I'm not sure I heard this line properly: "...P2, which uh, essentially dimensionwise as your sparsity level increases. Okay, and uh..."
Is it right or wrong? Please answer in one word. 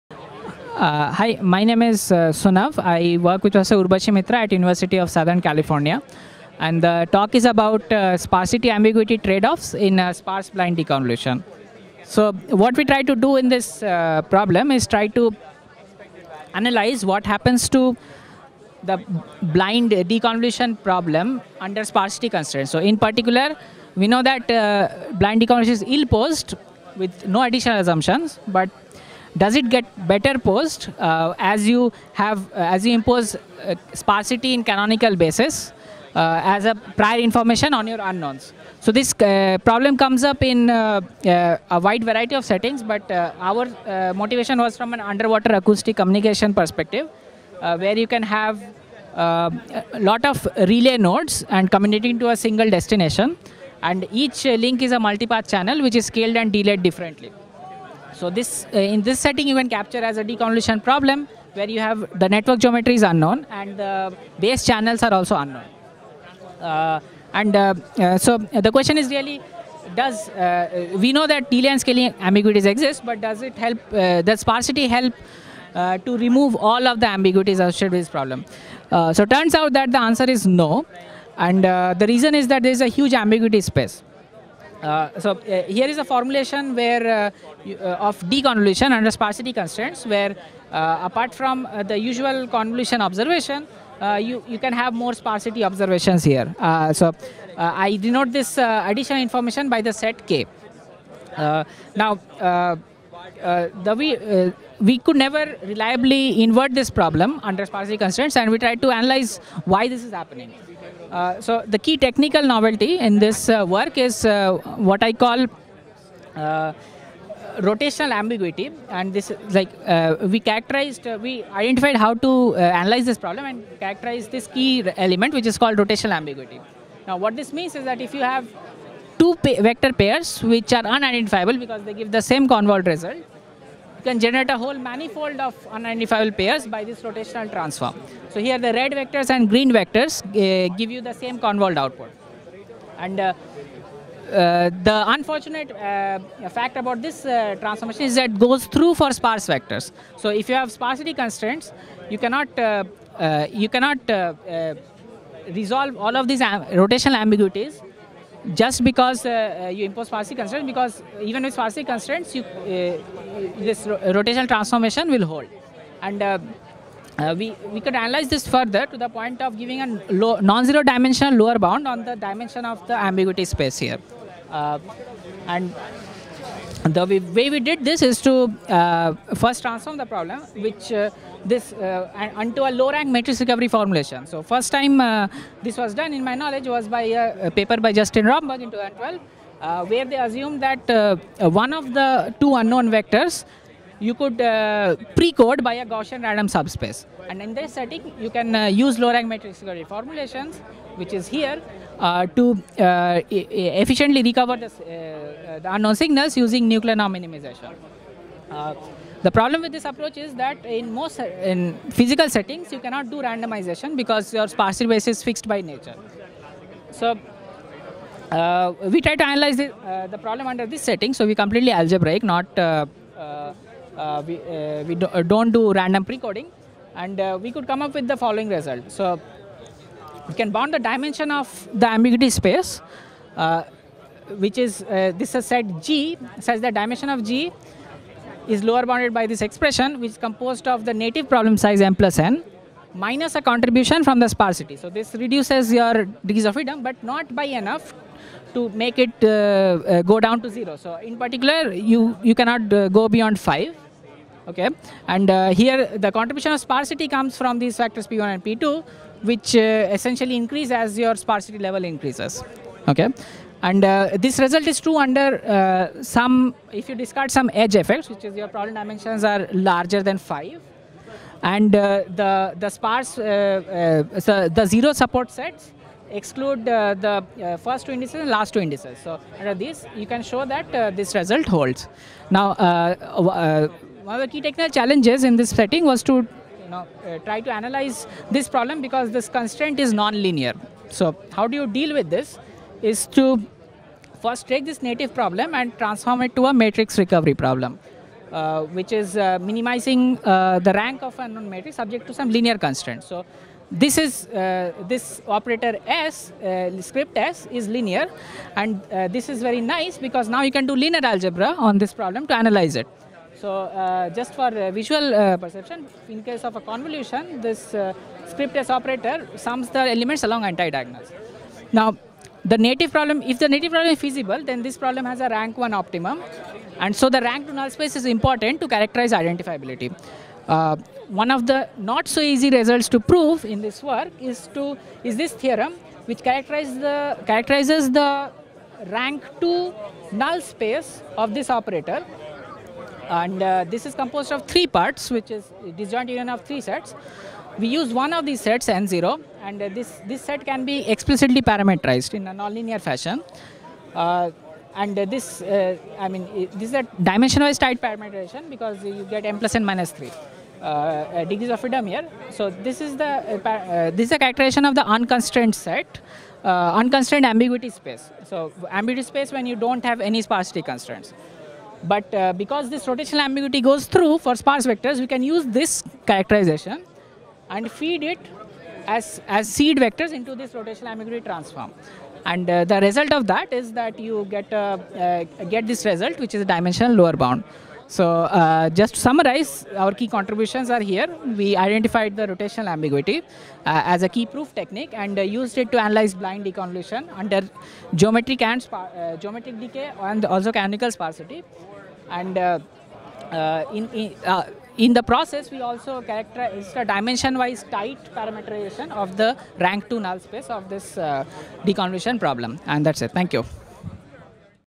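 wrong.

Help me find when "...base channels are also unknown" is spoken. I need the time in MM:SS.
01:04.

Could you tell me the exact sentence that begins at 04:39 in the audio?
So under this, you can show that uh, this result holds.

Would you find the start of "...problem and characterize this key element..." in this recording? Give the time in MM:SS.
02:03.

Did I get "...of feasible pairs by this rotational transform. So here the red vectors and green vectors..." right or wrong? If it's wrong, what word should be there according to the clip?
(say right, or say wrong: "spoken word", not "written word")
wrong: "unidentifiable", not "feasible".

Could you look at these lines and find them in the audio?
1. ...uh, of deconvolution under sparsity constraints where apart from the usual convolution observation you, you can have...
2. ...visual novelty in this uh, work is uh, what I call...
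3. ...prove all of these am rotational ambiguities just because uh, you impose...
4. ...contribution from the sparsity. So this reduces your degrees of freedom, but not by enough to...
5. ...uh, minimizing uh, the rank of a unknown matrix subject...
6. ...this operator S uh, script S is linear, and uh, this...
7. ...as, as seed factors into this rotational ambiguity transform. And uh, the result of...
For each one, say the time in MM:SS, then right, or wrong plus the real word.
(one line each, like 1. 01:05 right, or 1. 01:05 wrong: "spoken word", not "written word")
1. 01:27 right
2. 01:51 wrong: "technical", not "visual"
3. 02:35 wrong: "resolve", not "prove"
4. 04:03 right
5. 04:59 right
6. 05:04 right
7. 06:18 wrong: "vectors", not "factors".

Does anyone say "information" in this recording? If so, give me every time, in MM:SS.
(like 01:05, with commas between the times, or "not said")
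00:37, 01:39.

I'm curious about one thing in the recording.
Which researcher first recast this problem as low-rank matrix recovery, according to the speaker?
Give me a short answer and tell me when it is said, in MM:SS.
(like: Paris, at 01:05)
Justin Romberg, at 03:07.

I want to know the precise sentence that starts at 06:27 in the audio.
So uh, just to summarize, our key contributions are here.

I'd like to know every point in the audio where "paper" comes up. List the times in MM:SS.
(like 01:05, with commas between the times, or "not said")
03:07.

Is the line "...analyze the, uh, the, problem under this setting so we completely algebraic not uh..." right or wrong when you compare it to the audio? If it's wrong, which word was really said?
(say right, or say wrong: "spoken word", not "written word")
right.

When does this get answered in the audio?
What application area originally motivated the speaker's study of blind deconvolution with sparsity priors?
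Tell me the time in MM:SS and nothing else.
00:44.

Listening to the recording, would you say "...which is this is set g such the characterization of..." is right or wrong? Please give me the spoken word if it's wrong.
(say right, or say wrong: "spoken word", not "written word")
wrong: "dimension", not "characterization".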